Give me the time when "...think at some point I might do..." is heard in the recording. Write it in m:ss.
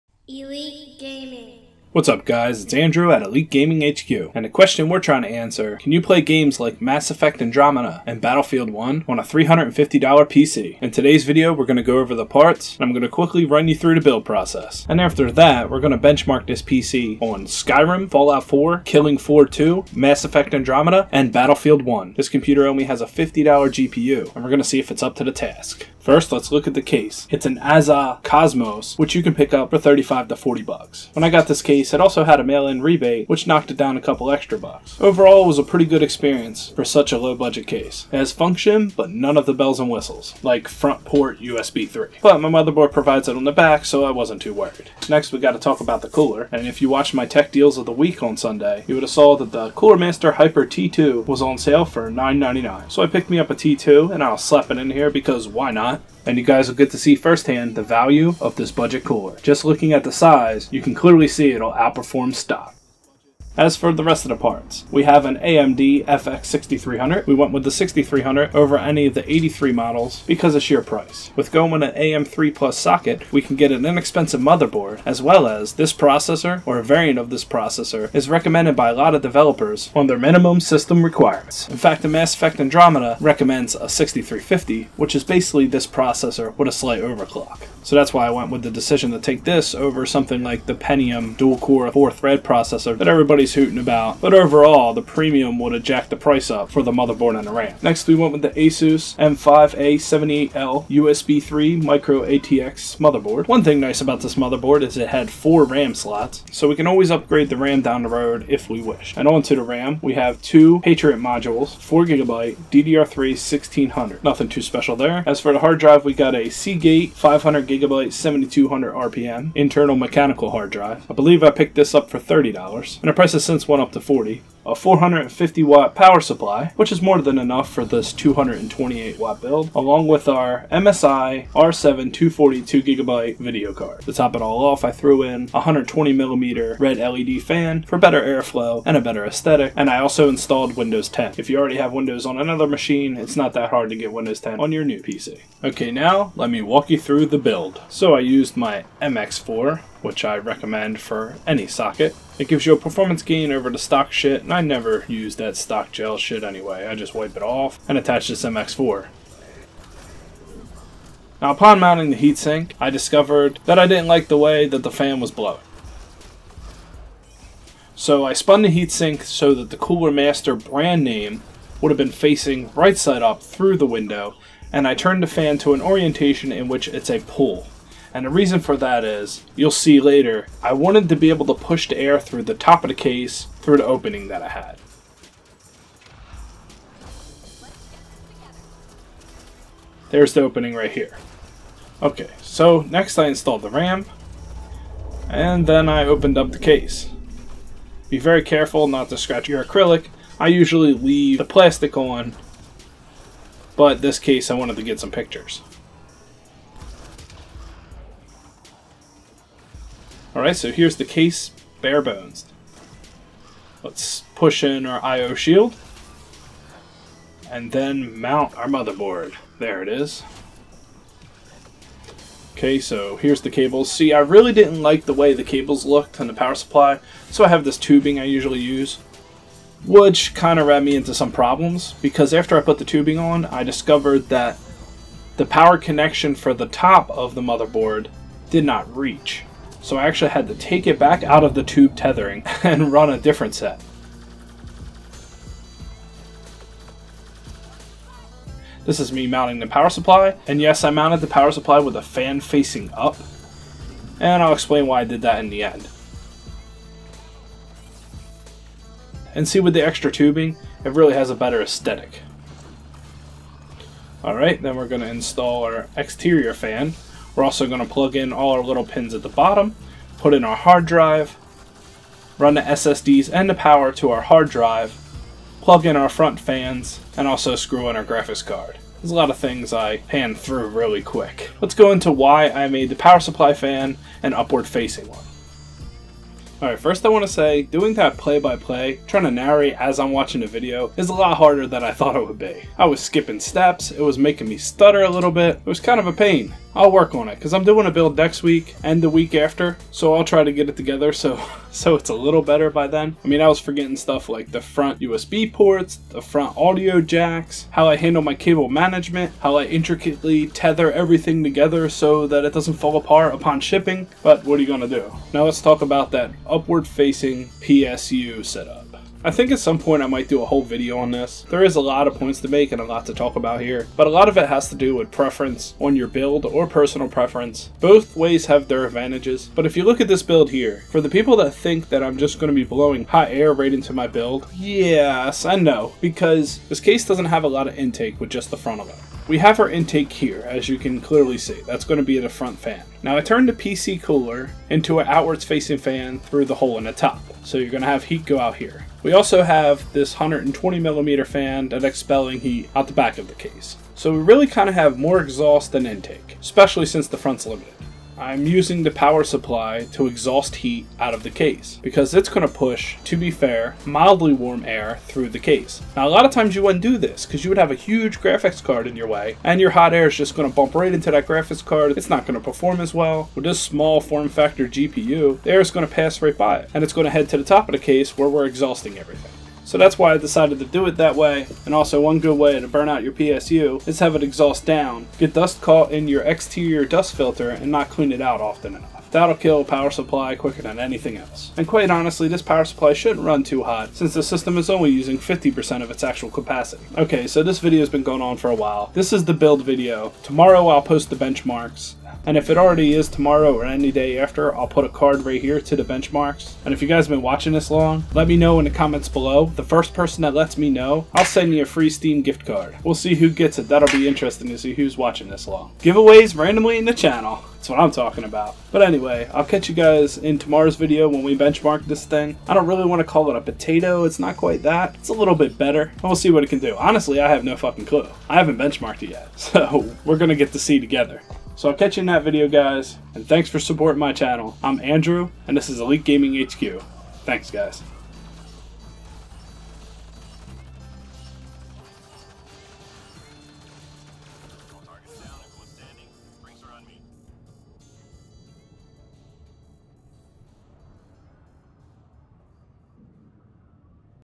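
5:19.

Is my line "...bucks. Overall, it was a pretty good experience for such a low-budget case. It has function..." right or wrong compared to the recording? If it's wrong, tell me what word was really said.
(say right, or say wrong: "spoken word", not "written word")
right.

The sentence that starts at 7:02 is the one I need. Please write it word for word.
I don't really want to call it a potato.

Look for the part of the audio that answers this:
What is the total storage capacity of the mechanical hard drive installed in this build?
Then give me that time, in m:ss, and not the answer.
1:57.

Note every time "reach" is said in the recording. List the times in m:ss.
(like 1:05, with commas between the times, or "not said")
3:58.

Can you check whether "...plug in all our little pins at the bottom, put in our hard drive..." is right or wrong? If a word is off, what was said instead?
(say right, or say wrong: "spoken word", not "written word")
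right.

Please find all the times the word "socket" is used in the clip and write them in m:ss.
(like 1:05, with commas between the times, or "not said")
1:12, 2:31.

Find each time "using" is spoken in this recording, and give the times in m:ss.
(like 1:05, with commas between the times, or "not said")
5:58, 6:34.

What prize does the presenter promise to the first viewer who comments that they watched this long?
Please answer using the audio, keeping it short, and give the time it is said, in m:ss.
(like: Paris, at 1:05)
Steam gift card, at 6:51.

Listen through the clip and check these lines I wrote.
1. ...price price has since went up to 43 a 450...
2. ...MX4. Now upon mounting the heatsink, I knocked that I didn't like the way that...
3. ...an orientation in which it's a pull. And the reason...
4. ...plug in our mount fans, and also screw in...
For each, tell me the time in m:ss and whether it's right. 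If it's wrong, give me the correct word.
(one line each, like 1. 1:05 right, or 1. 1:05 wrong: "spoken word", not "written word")
1. 2:03 wrong: "40", not "43"
2. 2:38 wrong: "discovered", not "knocked"
3. 2:55 right
4. 4:35 wrong: "front", not "mount".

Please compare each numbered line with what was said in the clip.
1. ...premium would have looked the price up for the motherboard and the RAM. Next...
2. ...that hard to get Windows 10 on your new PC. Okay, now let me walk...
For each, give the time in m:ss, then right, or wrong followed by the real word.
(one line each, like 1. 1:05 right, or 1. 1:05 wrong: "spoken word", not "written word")
1. 1:35 wrong: "jacked", not "looked"
2. 2:23 right.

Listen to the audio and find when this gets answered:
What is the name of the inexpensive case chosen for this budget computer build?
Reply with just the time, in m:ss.
0:27.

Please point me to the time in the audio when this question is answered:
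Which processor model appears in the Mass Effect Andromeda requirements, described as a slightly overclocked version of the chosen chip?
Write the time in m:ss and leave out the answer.
1:23.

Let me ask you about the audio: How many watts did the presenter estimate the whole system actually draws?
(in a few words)
228 watt.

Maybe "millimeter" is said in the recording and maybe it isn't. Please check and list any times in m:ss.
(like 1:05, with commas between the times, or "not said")
2:16, 5:50.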